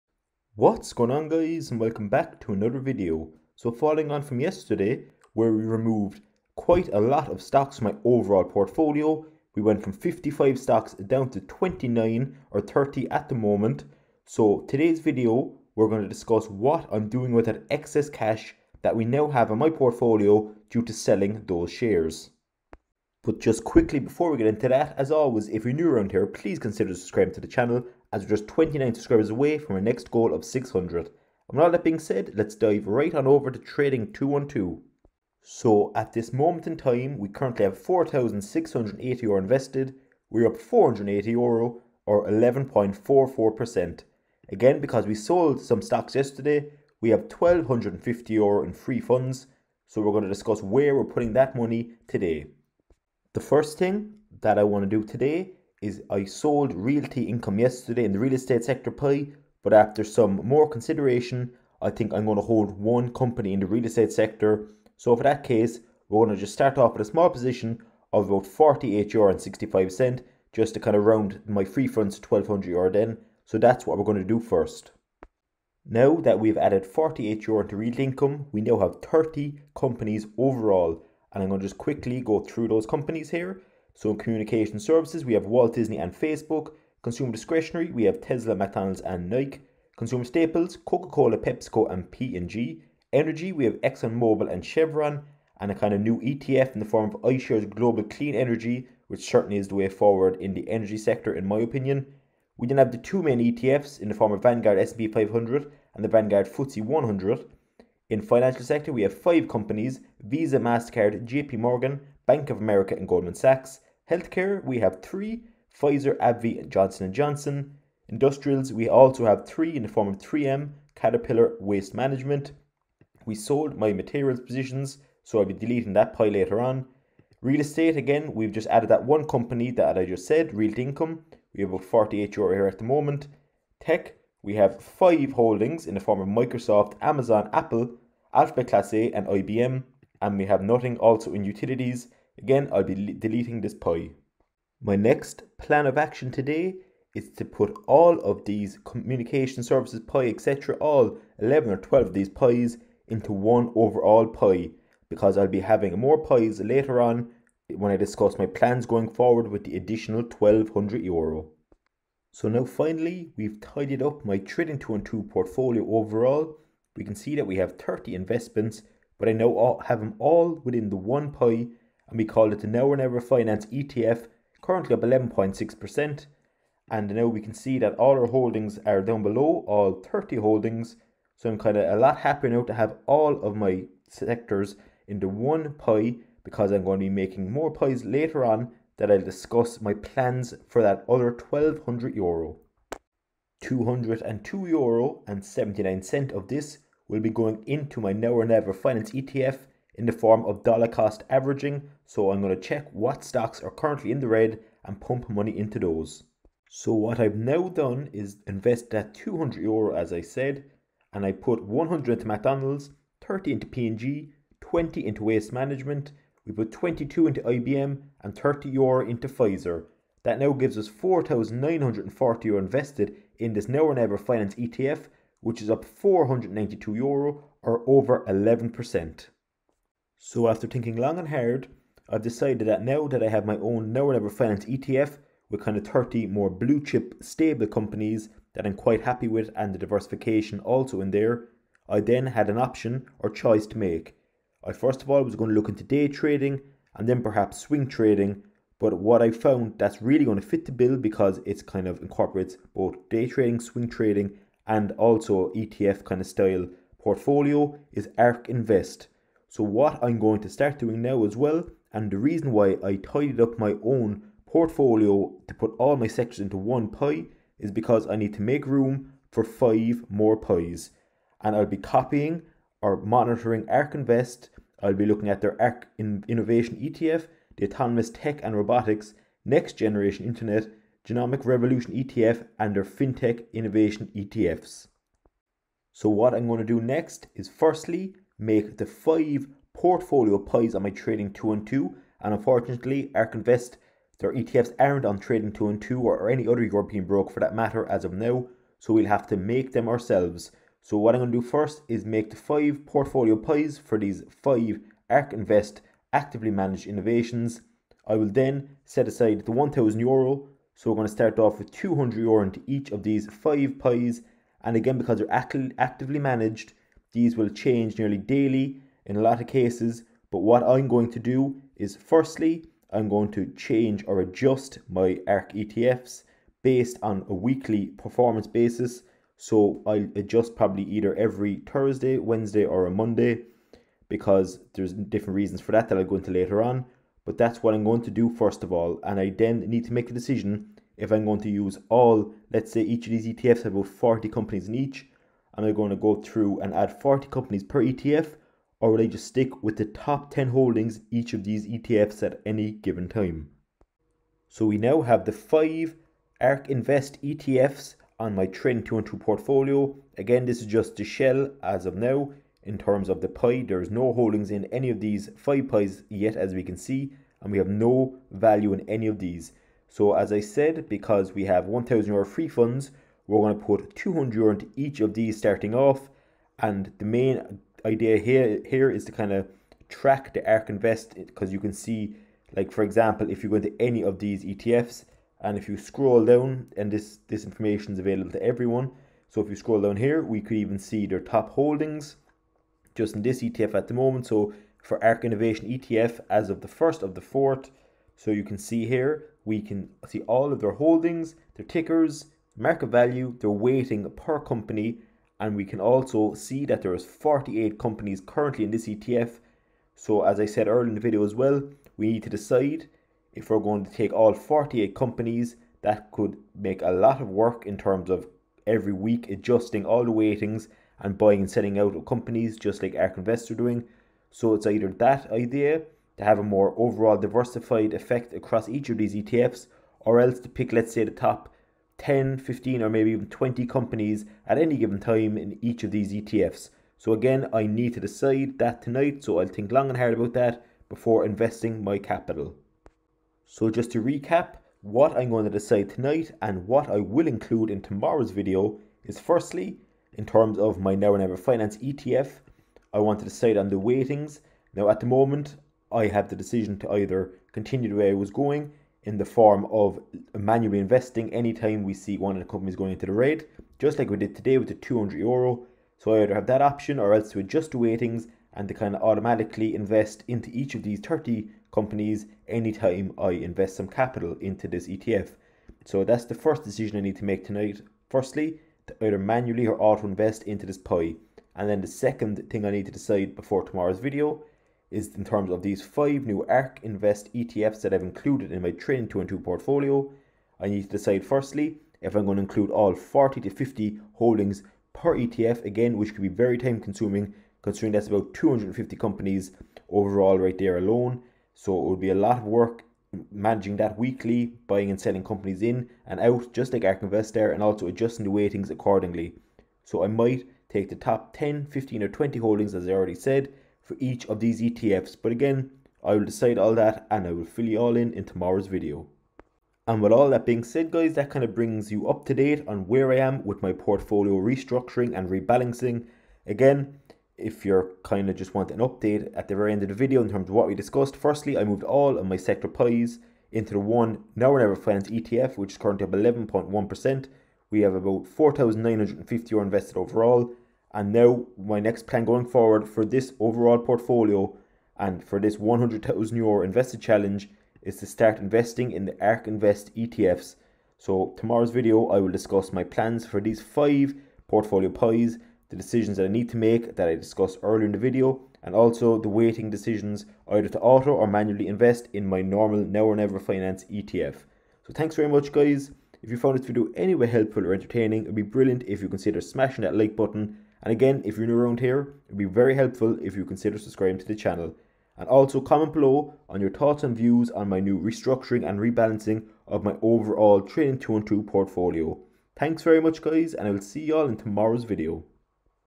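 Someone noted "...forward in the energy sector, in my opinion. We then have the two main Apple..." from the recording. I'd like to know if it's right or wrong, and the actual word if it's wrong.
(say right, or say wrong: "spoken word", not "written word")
wrong: "ETFs", not "Apple".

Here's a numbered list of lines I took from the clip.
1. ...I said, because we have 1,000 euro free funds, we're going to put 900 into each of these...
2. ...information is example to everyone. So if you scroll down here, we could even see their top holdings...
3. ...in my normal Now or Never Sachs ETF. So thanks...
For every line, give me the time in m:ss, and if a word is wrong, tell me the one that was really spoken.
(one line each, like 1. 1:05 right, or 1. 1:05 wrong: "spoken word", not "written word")
1. 6:10 wrong: "200", not "900"
2. 6:27 wrong: "available", not "example"
3. 9:22 wrong: "Finance", not "Sachs".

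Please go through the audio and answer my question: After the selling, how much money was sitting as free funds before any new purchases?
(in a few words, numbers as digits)
1250 euro.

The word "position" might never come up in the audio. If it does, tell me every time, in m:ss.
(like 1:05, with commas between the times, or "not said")
1:07, 2:04.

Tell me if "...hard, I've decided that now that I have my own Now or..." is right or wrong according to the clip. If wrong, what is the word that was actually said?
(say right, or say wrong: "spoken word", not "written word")
right.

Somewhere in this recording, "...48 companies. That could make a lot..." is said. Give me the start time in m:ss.
6:54.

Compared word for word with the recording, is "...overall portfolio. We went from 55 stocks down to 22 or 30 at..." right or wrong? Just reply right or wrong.
wrong.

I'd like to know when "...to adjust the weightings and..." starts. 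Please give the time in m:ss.
7:47.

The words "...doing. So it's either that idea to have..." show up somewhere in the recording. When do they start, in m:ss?
7:03.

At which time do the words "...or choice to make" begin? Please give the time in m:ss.
4:03.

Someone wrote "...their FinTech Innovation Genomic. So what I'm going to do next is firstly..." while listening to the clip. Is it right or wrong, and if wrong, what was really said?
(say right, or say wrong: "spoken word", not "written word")
wrong: "ETFs", not "Genomic".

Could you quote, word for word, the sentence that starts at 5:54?
So we now have the five ARK Invest ETFs on my Trading 212 portfolio.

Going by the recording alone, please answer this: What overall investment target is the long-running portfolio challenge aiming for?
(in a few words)
100,000 euro.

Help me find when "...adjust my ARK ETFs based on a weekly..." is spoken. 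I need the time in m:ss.
5:24.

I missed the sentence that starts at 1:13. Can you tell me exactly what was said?
So that's what we're going to do first.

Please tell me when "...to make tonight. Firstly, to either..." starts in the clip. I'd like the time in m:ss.
7:57.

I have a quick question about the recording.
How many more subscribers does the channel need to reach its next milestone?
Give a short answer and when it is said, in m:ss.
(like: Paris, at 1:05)
29, at 0:28.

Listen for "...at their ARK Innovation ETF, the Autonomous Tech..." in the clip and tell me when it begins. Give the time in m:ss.
4:35.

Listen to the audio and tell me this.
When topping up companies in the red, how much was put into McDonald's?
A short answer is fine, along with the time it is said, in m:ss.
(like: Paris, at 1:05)
100, at 3:31.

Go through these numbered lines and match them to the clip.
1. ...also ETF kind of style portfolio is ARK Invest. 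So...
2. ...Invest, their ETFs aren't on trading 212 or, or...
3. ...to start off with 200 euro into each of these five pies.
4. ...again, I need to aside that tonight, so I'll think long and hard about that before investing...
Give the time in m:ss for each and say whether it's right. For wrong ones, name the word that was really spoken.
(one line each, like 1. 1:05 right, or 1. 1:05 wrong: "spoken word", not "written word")
1. 4:14 right
2. 4:53 right
3. 5:11 right
4. 7:17 wrong: "decide", not "aside".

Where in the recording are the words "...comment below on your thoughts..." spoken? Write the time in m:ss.
9:35.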